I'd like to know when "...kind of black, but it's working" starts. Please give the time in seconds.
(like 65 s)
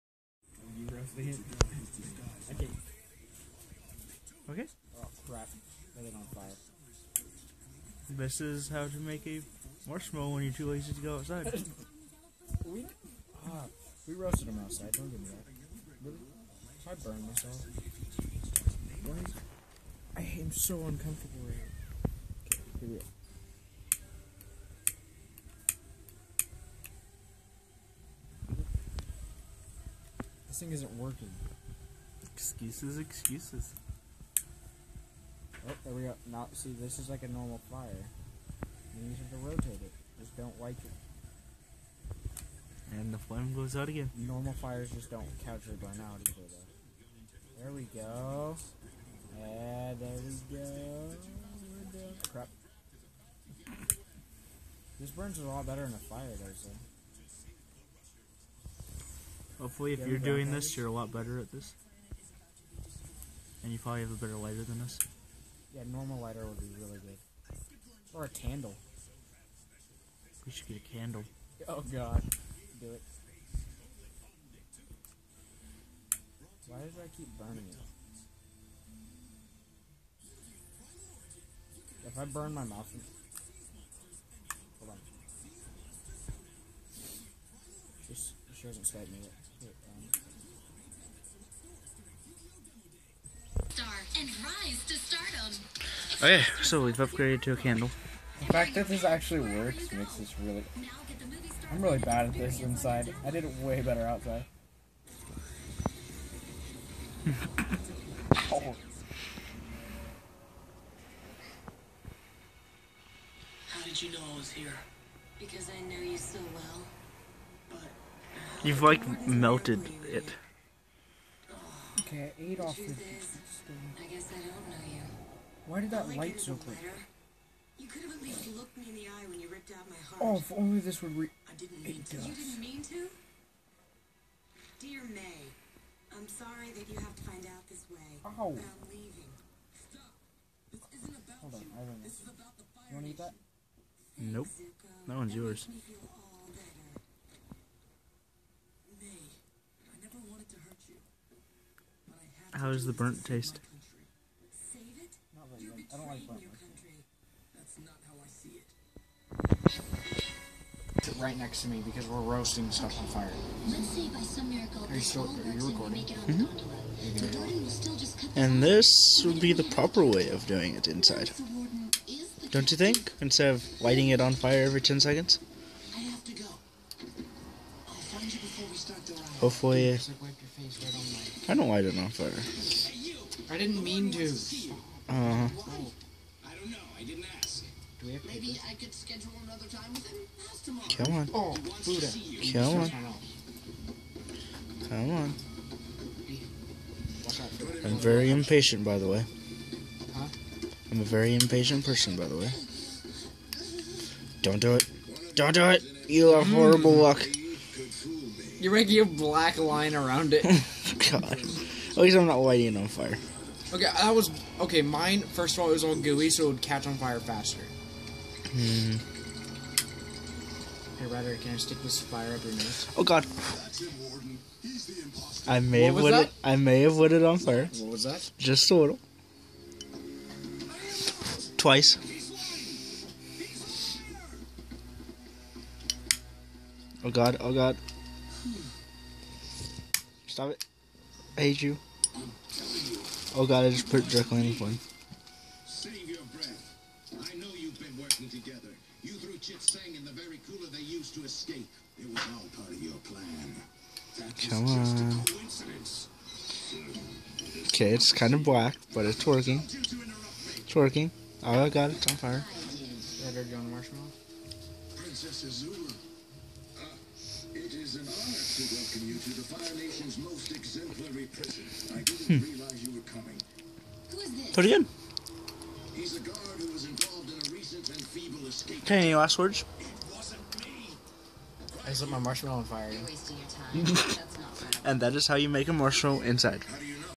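258 s.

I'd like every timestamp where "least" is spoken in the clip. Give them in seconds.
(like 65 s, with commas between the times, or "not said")
128 s, 211 s.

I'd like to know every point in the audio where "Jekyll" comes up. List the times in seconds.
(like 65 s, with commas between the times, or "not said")
244 s.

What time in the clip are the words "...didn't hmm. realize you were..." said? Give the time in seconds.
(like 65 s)
272 s.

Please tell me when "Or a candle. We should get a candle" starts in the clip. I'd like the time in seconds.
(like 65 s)
68 s.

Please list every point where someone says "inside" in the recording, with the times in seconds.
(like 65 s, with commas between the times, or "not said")
102 s, 170 s, 286 s.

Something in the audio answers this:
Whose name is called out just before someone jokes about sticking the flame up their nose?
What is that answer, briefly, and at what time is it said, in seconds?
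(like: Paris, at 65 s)
Ryder, at 221 s.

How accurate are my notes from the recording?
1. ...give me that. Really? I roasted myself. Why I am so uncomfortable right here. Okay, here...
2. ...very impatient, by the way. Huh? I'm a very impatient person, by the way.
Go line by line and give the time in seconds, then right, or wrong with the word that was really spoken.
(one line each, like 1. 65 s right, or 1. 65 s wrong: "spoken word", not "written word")
1. 15 s wrong: "burned", not "roasted"
2. 197 s right.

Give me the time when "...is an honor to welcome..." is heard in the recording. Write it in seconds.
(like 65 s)
267 s.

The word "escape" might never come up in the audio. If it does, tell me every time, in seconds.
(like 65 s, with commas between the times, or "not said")
251 s, 278 s.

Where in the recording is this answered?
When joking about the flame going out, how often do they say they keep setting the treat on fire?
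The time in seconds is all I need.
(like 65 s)
174 s.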